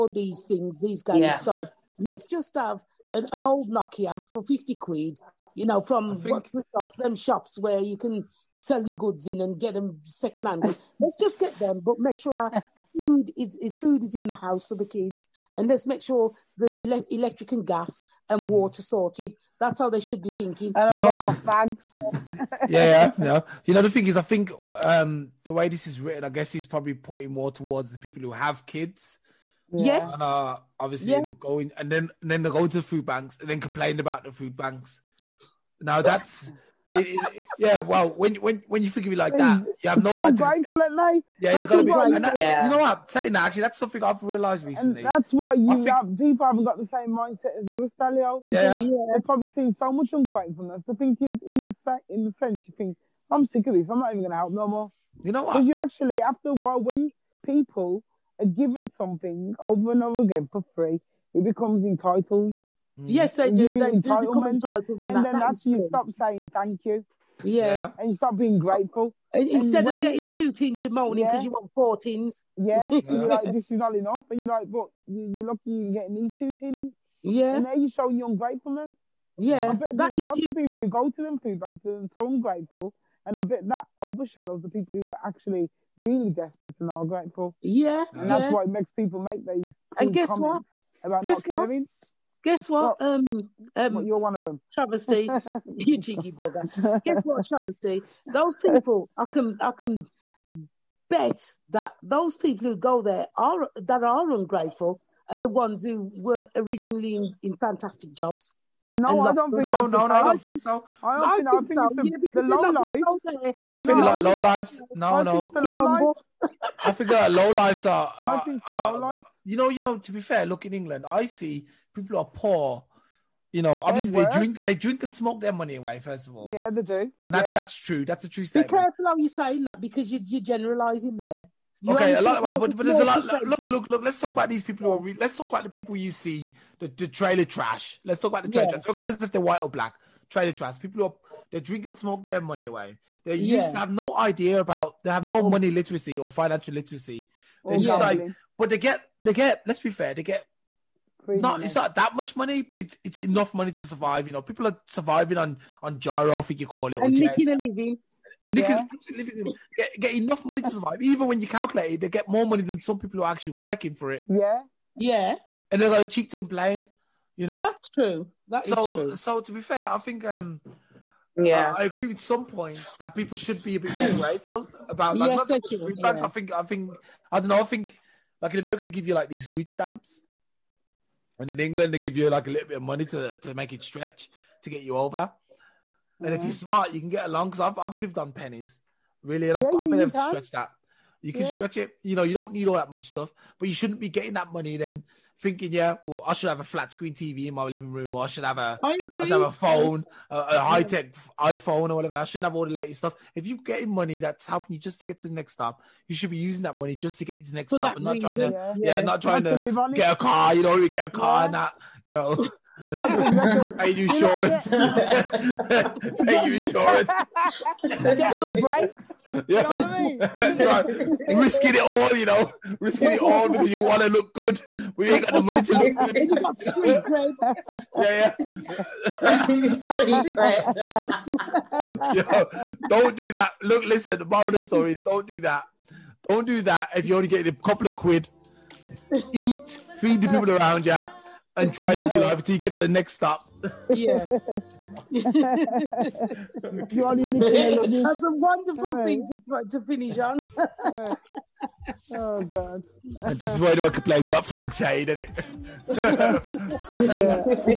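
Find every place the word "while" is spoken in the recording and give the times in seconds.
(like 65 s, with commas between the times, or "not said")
56 s.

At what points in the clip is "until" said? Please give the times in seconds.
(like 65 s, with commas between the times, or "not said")
242 s.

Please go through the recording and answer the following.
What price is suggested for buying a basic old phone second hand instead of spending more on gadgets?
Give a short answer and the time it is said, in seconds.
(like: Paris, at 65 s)
50 quid, at 4 s.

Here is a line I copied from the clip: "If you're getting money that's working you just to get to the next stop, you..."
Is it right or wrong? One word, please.
wrong.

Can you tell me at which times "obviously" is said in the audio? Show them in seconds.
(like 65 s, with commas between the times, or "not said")
30 s, 123 s.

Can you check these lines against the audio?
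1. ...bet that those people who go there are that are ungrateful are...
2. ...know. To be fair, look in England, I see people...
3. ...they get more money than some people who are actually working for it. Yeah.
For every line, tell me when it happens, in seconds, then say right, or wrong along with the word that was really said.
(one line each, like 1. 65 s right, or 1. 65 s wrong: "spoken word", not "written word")
1. 101 s right
2. 119 s right
3. 161 s right.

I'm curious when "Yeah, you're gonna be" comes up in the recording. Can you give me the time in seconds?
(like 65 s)
41 s.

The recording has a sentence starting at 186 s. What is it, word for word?
And if you're smart, you can get along.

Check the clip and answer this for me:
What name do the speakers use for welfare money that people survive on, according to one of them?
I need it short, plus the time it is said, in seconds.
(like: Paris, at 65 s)
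giro, at 155 s.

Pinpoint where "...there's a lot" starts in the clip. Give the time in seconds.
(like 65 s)
132 s.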